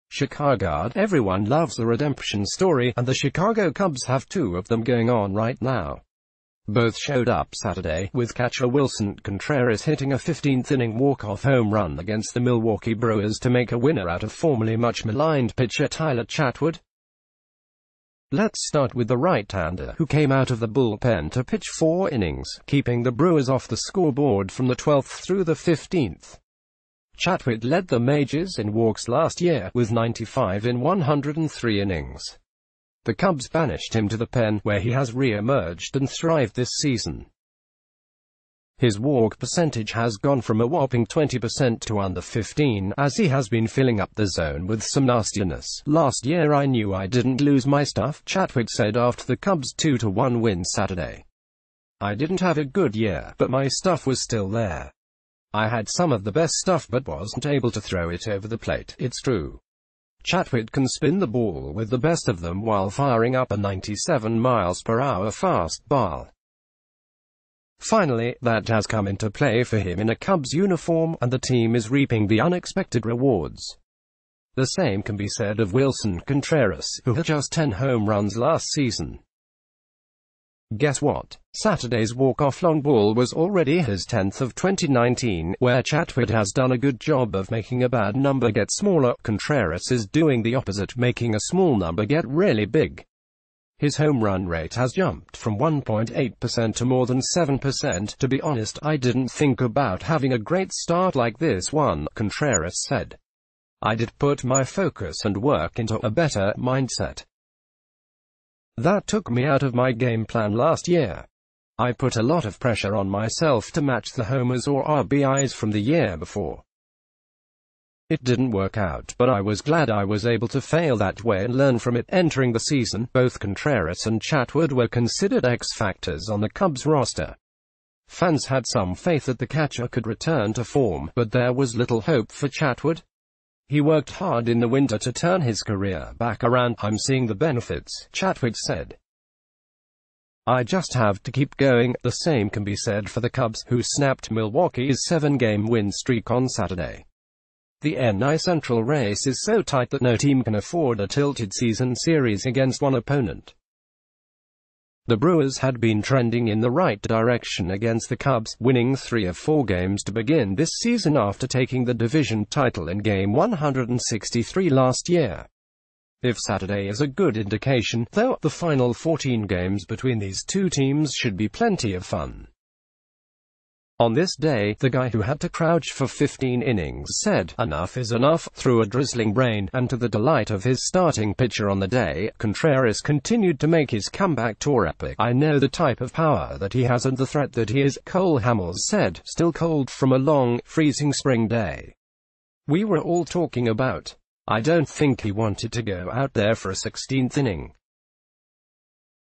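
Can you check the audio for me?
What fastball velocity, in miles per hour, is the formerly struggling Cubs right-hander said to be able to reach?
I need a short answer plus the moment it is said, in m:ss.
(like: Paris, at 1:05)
97, at 1:03.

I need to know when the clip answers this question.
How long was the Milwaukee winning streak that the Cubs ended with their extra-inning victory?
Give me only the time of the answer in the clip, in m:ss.
2:25.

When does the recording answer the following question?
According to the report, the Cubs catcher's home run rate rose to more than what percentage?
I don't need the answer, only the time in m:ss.
1:37.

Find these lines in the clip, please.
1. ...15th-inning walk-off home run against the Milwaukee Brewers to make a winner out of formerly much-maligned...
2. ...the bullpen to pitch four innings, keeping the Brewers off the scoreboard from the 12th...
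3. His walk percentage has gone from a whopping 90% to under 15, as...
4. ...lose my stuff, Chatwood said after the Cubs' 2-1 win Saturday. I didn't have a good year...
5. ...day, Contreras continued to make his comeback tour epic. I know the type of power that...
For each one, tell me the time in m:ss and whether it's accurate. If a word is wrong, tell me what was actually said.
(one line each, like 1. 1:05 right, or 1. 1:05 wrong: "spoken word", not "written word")
1. 0:10 right
2. 0:20 right
3. 0:38 wrong: "20", not "90"
4. 0:47 right
5. 3:01 right.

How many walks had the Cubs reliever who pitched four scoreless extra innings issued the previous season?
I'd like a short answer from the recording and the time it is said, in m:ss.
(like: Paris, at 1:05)
95, at 0:29.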